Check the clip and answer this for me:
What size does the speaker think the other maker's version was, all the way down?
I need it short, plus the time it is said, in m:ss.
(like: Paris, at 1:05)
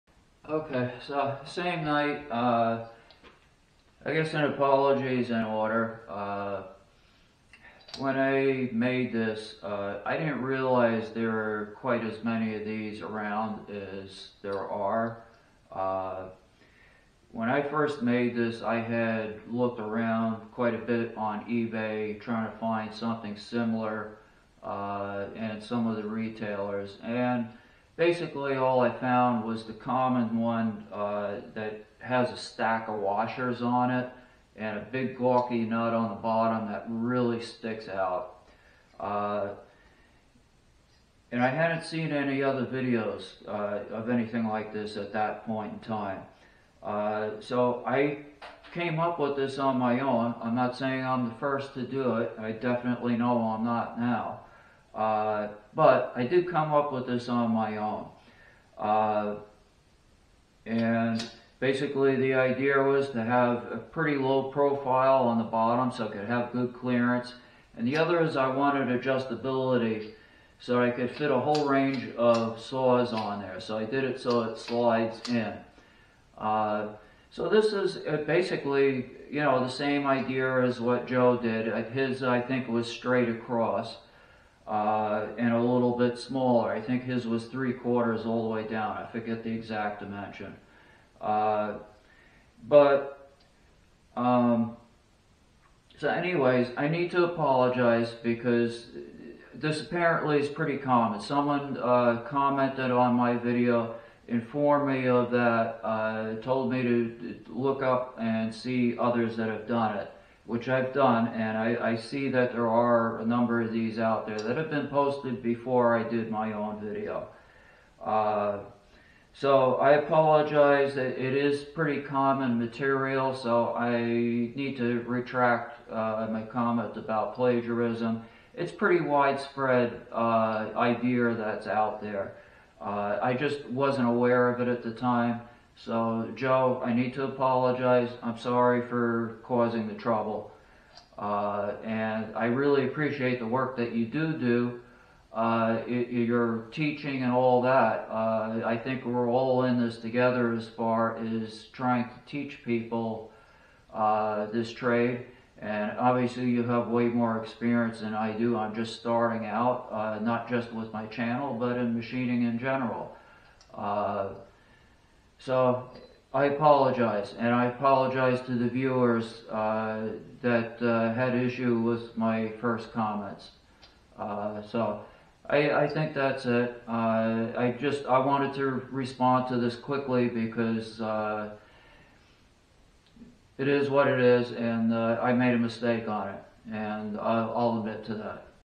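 3/4, at 1:27.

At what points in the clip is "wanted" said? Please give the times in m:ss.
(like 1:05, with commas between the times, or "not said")
1:08, 2:58.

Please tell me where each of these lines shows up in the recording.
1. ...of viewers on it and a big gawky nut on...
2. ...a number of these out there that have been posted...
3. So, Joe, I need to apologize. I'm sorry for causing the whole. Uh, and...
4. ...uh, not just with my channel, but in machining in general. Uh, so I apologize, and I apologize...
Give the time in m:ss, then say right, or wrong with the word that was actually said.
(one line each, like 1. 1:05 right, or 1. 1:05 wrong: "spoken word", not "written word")
1. 0:32 wrong: "washers", not "viewers"
2. 1:53 right
3. 2:15 wrong: "trouble", not "whole"
4. 2:39 right.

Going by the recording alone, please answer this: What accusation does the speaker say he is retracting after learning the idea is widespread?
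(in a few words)
Plagiarism.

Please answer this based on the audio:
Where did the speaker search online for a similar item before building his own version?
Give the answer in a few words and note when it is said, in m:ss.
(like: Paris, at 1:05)
eBay, at 0:21.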